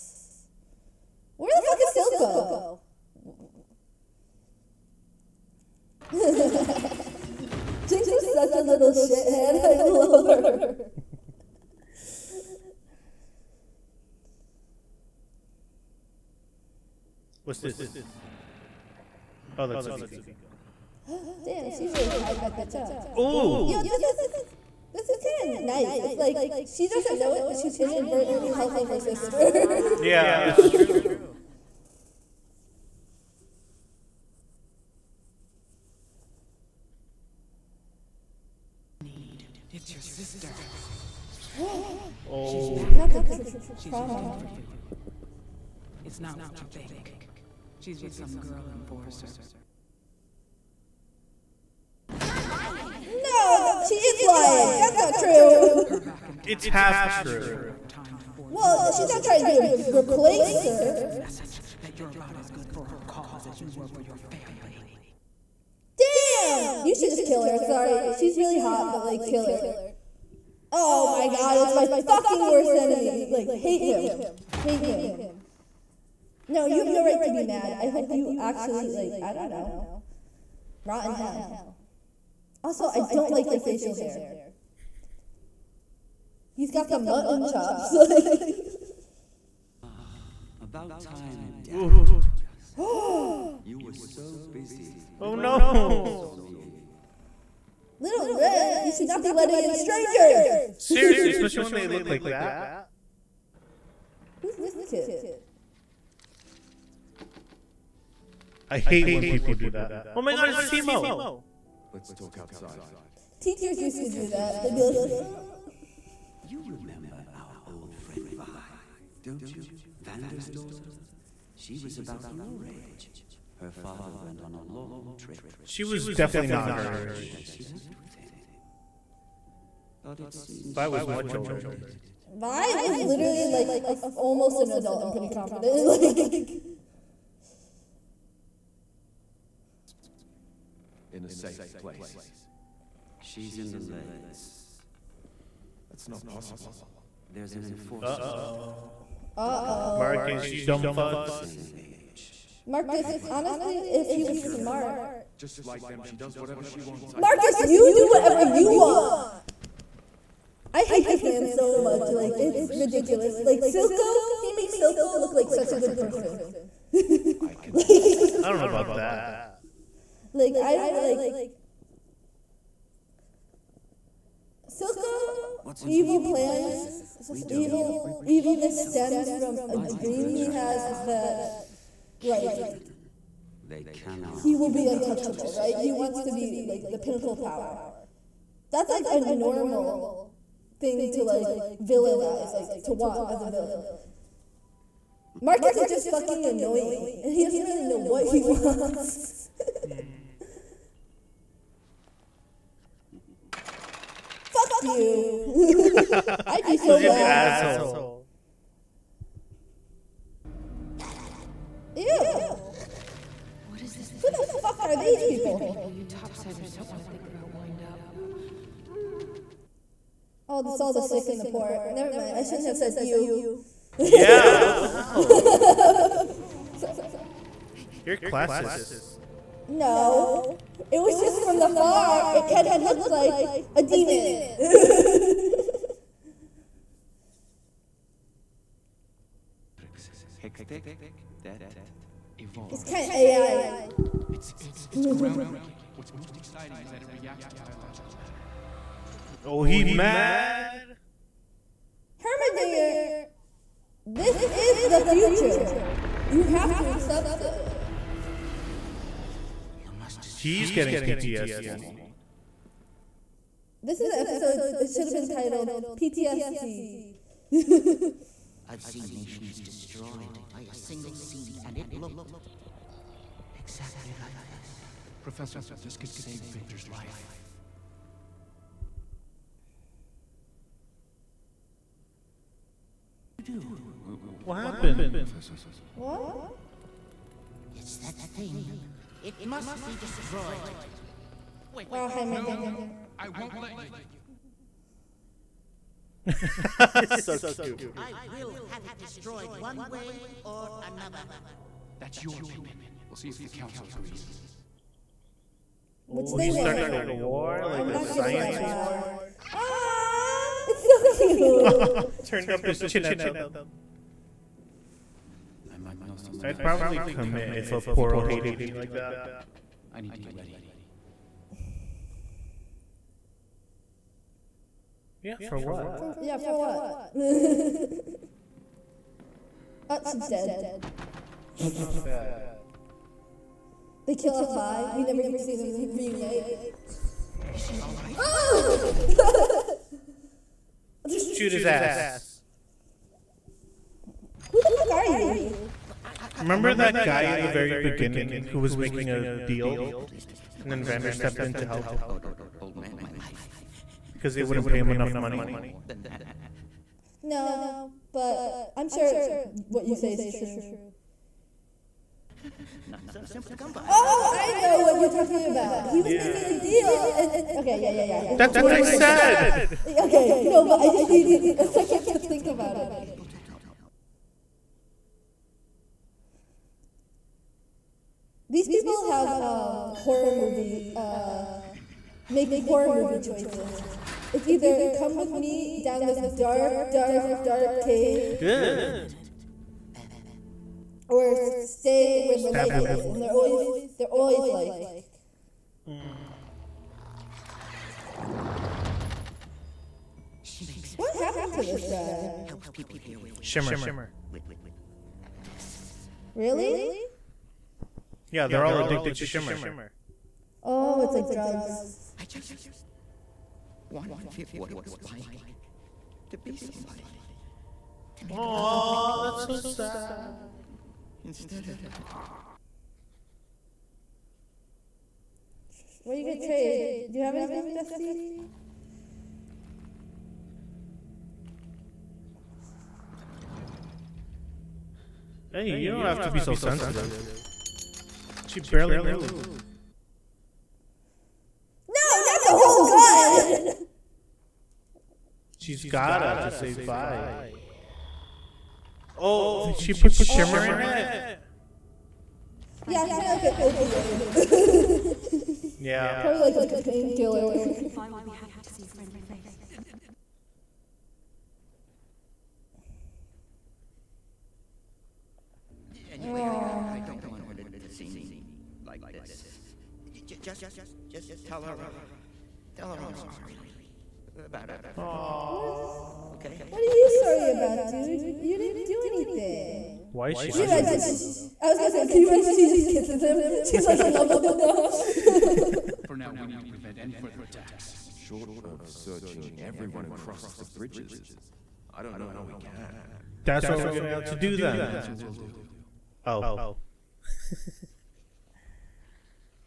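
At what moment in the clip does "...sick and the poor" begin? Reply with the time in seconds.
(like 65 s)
221 s.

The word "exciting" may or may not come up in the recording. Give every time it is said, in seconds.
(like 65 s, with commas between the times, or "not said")
246 s.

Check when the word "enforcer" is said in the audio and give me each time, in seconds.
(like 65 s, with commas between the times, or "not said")
48 s, 147 s.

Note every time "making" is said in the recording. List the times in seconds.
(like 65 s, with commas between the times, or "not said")
348 s, 366 s.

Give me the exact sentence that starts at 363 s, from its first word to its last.
Oh, I know what you're talking about.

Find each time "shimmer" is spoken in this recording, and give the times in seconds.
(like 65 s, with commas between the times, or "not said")
403 s, 409 s, 450 s.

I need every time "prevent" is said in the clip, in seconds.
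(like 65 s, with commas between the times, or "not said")
486 s.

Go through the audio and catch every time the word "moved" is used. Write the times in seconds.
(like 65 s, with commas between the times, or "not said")
438 s.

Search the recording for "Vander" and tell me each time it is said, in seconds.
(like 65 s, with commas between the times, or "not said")
120 s, 350 s.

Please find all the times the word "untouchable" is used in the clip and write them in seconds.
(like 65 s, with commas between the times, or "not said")
184 s.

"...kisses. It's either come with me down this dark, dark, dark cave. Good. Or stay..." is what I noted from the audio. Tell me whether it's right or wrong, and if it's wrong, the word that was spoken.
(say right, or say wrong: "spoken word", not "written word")
wrong: "choices", not "kisses".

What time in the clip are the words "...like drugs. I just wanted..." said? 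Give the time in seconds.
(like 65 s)
411 s.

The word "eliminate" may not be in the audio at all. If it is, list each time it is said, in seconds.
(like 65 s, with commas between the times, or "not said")
not said.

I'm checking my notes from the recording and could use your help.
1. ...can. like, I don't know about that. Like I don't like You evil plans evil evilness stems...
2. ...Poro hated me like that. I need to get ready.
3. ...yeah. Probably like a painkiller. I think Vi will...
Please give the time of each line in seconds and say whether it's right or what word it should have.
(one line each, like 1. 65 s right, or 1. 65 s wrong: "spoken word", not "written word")
1. 167 s wrong: "Silco", not "You"
2. 317 s right
3. 455 s right.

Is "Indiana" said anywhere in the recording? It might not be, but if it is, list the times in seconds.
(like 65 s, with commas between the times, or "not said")
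not said.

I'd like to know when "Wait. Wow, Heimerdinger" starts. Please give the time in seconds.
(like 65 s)
291 s.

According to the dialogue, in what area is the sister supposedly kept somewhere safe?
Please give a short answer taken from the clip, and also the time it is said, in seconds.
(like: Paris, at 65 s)
The lanes, at 143 s.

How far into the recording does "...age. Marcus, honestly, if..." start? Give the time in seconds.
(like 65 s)
151 s.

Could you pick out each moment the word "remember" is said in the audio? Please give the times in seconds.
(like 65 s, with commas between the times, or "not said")
116 s, 346 s.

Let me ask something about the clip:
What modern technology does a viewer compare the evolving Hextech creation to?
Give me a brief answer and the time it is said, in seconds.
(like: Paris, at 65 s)
AI, at 243 s.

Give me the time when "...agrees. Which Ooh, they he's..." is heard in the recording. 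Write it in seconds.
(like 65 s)
303 s.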